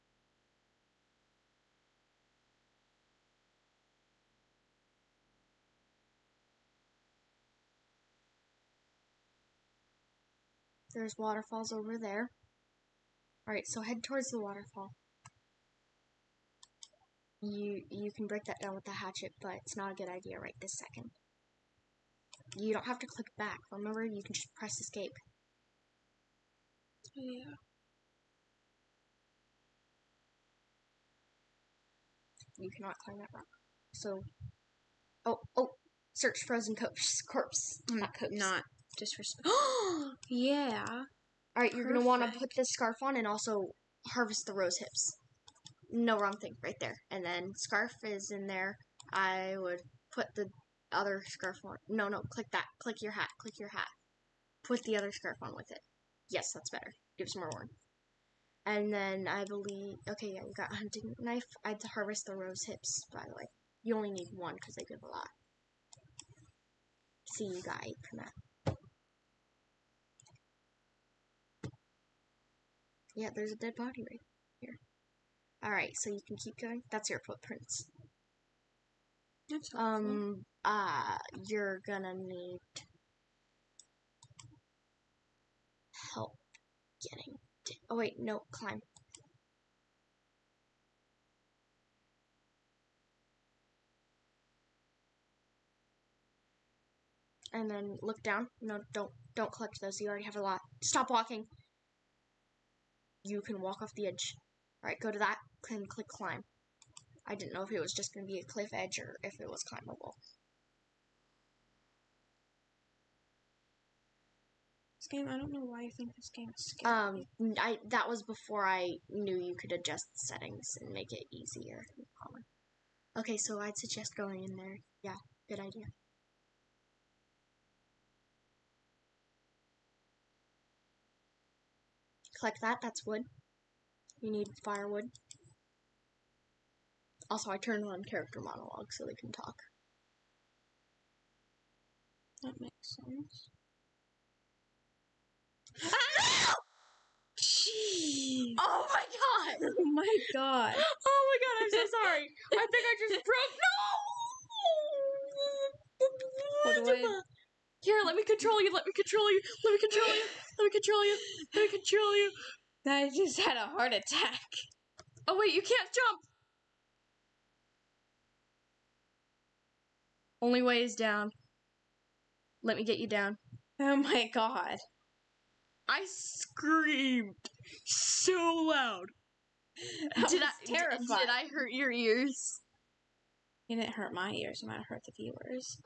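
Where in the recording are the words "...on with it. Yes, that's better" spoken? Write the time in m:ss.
0:55.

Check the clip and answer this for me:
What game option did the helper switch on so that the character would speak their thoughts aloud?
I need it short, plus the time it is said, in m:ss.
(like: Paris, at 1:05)
character monologue, at 2:18.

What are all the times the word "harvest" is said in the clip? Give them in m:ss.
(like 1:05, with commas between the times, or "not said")
0:44, 1:01.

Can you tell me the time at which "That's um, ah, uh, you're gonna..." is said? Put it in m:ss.
1:19.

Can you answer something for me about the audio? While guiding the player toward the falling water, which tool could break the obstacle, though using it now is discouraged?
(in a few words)
hatchet.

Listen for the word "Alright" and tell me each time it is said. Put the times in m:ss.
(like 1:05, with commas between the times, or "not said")
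0:13, 1:15, 1:44.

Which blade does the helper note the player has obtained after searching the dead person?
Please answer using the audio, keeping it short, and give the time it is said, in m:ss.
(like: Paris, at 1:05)
hunting knife, at 1:00.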